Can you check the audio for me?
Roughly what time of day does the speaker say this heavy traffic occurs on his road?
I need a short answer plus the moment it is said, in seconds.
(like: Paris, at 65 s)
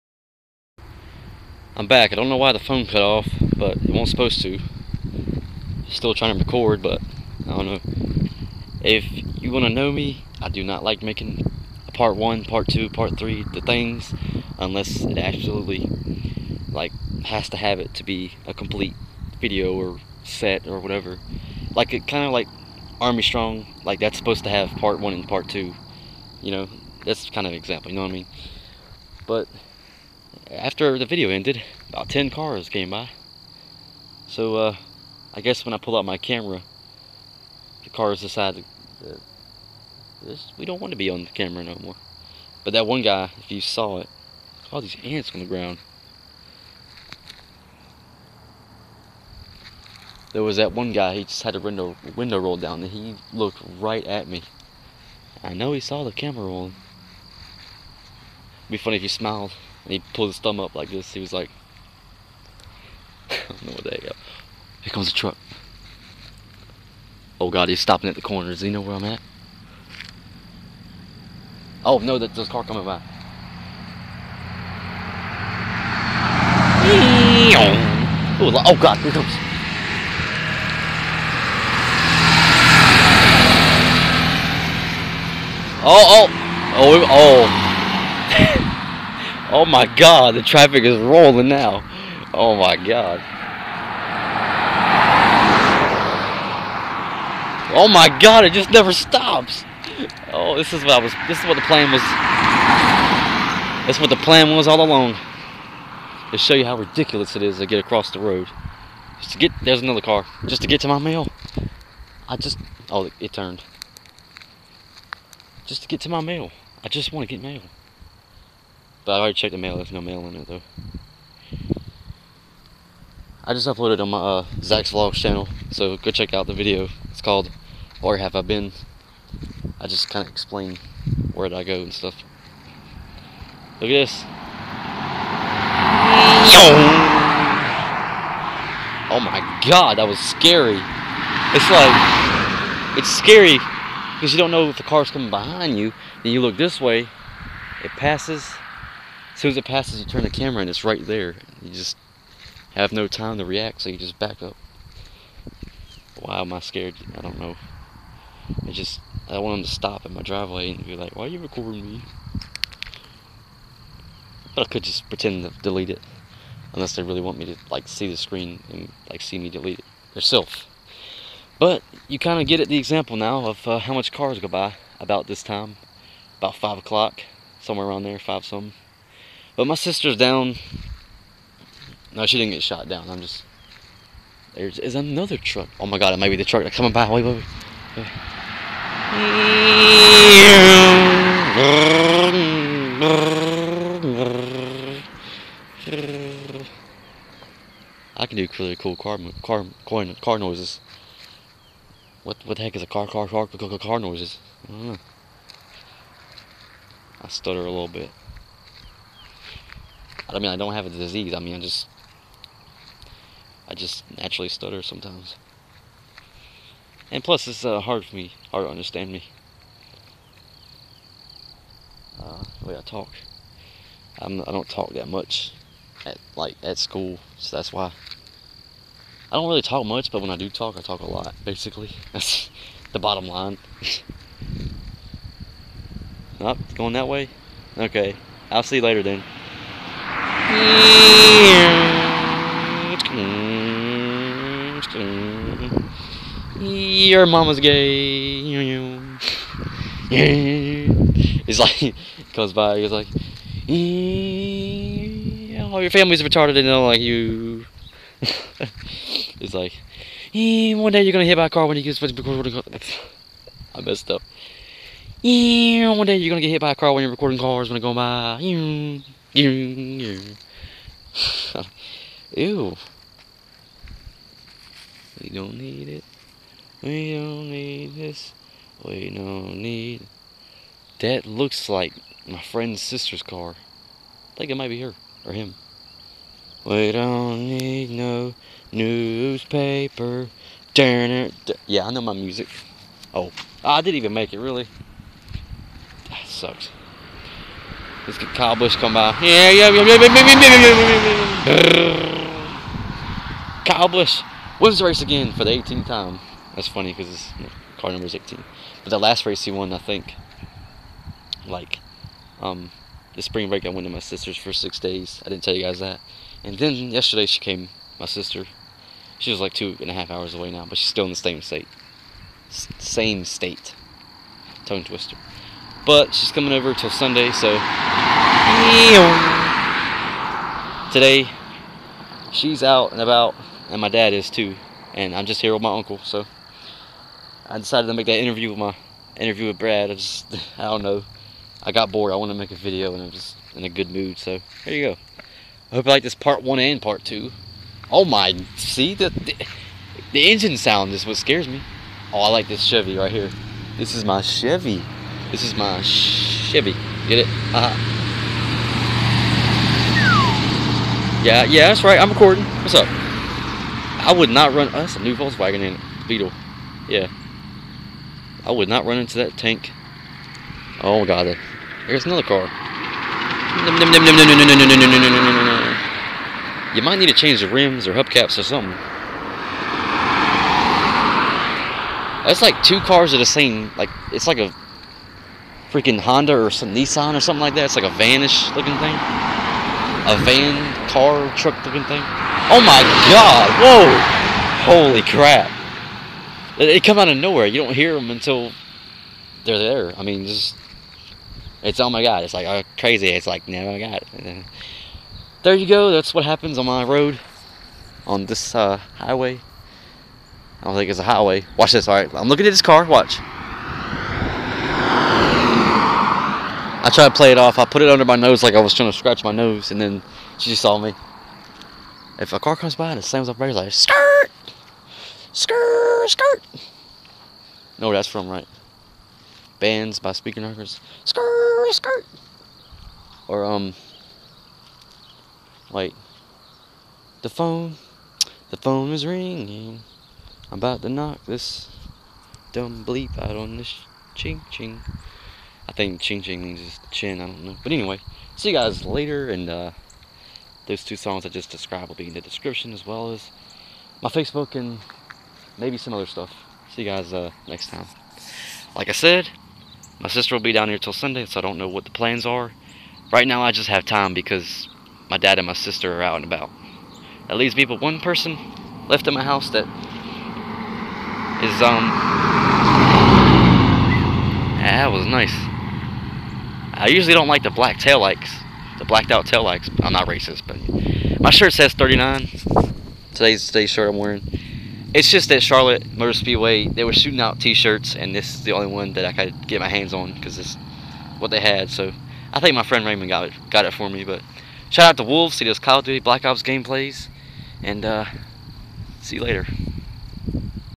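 5 o'clock, at 176 s.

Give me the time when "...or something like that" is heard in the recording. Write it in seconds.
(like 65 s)
387 s.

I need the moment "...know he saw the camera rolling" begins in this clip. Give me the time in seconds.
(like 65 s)
55 s.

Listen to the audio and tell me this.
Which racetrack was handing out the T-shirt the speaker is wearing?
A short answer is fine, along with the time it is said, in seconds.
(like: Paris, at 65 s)
Charlotte Motor Speedway, at 485 s.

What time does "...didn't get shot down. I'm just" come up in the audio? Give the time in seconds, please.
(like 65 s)
182 s.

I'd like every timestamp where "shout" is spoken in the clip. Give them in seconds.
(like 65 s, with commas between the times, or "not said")
494 s.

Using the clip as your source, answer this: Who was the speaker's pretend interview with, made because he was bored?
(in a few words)
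Brad.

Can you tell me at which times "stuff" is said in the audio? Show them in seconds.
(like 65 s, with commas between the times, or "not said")
131 s, 456 s.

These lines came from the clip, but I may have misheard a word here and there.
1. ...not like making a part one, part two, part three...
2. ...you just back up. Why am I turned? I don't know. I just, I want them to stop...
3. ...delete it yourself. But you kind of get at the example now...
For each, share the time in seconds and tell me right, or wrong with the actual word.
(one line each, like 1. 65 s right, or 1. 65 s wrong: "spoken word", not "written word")
1. 10 s right
2. 153 s wrong: "scared", not "turned"
3. 169 s right.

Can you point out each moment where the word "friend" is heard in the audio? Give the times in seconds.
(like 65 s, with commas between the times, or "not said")
282 s, 492 s.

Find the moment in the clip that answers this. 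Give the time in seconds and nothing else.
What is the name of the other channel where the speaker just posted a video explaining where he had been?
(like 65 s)
124 s.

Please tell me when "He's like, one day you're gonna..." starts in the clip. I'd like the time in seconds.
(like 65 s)
259 s.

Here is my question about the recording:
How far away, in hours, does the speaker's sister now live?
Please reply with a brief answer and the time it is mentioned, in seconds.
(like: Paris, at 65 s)
2.5 hours, at 319 s.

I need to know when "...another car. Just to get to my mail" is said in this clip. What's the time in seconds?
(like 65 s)
109 s.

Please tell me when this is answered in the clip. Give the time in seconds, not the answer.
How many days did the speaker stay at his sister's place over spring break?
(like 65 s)
314 s.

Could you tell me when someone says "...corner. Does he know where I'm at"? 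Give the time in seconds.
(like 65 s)
68 s.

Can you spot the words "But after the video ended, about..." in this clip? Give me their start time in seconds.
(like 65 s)
29 s.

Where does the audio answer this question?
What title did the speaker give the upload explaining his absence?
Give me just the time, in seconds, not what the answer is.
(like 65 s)
127 s.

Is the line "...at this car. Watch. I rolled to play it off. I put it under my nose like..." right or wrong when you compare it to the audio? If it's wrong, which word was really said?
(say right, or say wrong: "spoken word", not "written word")
wrong: "tried", not "rolled".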